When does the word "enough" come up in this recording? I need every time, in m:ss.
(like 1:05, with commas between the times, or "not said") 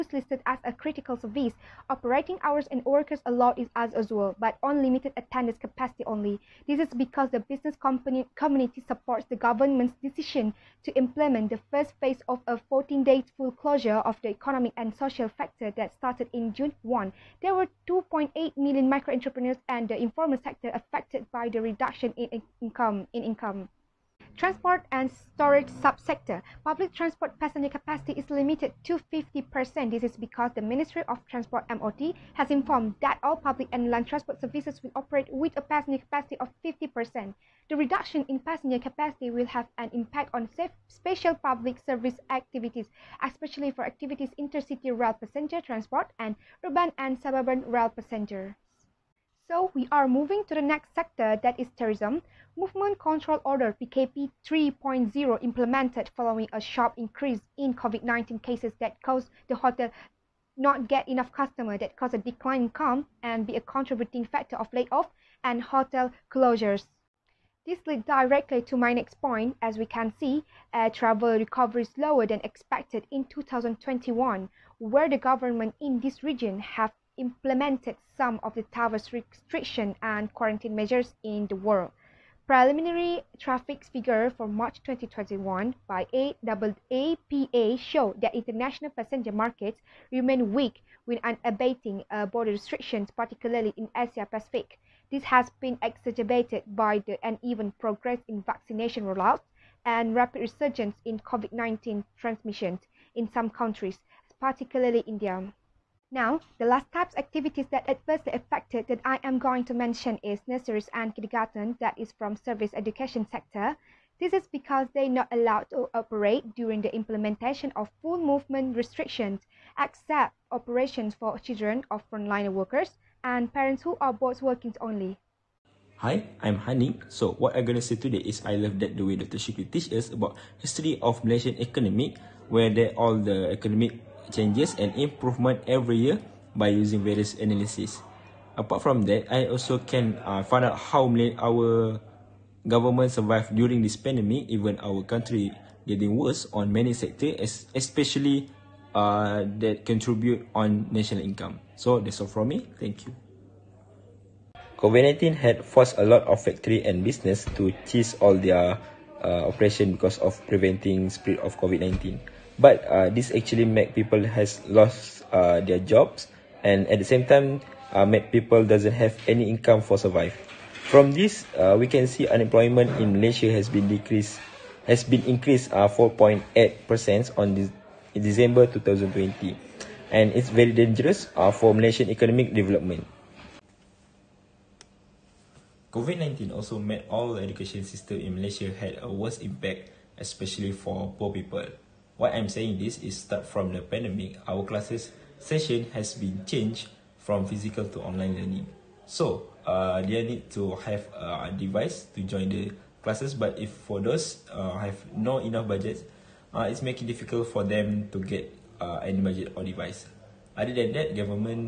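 1:01, 3:25.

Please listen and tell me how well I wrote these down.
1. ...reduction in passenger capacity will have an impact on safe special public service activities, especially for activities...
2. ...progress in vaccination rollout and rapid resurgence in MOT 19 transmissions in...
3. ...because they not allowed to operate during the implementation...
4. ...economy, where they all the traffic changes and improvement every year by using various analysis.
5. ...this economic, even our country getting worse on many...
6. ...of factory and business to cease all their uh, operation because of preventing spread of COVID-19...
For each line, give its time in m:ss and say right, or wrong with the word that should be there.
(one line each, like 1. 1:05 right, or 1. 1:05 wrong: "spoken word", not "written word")
1. 0:37 right
2. 1:37 wrong: "COVID", not "MOT"
3. 1:54 right
4. 2:11 wrong: "economic", not "traffic"
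5. 2:23 wrong: "pandemic", not "economic"
6. 2:36 right.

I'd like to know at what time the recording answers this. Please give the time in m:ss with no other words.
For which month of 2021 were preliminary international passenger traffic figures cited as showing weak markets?
1:24.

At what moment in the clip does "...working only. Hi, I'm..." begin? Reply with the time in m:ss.
2:04.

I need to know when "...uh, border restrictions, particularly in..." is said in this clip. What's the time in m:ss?
1:32.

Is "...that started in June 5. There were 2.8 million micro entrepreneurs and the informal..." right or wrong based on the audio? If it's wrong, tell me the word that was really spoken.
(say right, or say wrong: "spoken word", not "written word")
wrong: "1", not "5".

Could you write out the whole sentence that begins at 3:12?
Why I'm saying this is start from the pandemic, our classes session has been changed from physical to online learning.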